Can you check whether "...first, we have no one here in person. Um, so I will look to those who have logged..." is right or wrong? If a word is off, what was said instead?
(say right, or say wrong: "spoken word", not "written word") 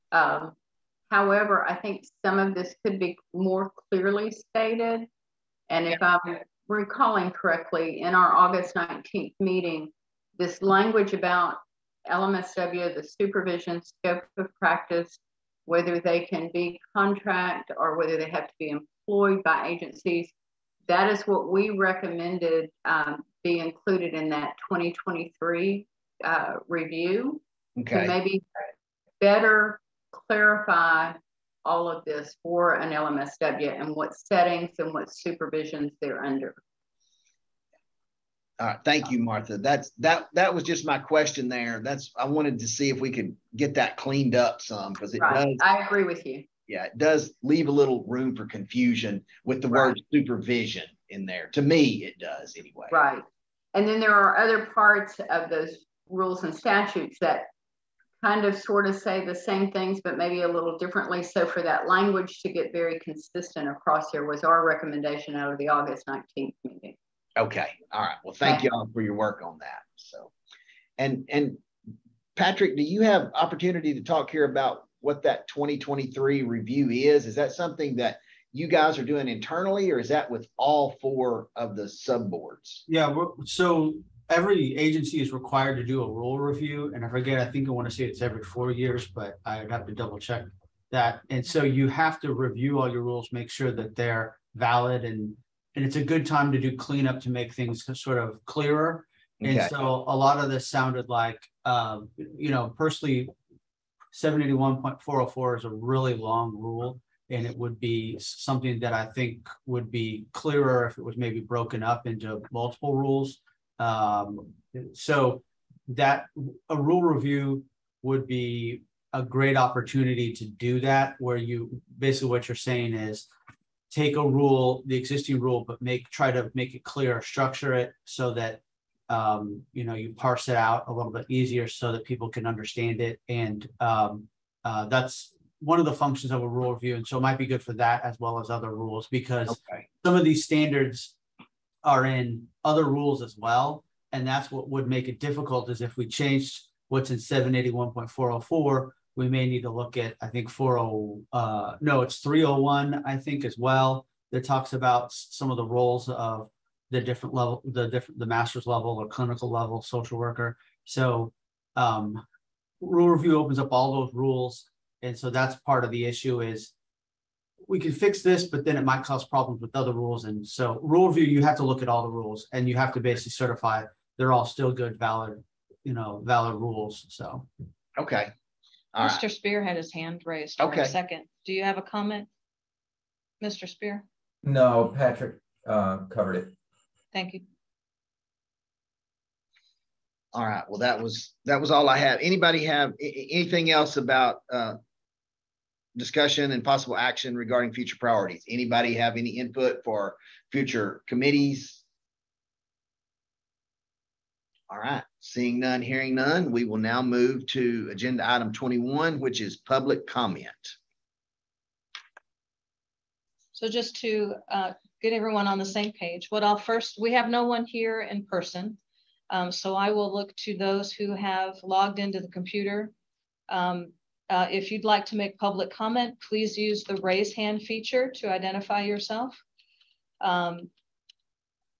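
right.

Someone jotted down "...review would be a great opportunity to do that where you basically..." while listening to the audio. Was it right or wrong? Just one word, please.
right.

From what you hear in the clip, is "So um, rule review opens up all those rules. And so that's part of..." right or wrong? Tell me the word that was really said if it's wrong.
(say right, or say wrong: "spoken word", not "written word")
right.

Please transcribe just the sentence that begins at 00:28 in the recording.
to maybe better clarify all of this for an LMSW and what settings and what supervisions they're under.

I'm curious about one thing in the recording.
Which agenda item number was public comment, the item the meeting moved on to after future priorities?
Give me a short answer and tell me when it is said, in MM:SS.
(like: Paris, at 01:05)
21, at 03:28.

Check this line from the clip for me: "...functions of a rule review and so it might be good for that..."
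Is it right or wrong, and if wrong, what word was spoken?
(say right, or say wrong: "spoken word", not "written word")
right.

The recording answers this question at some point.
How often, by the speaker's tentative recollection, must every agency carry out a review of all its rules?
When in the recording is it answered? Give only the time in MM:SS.
01:28.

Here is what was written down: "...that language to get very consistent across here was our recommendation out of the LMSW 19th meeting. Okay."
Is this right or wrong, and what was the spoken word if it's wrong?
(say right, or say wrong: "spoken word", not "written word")
wrong: "August", not "LMSW".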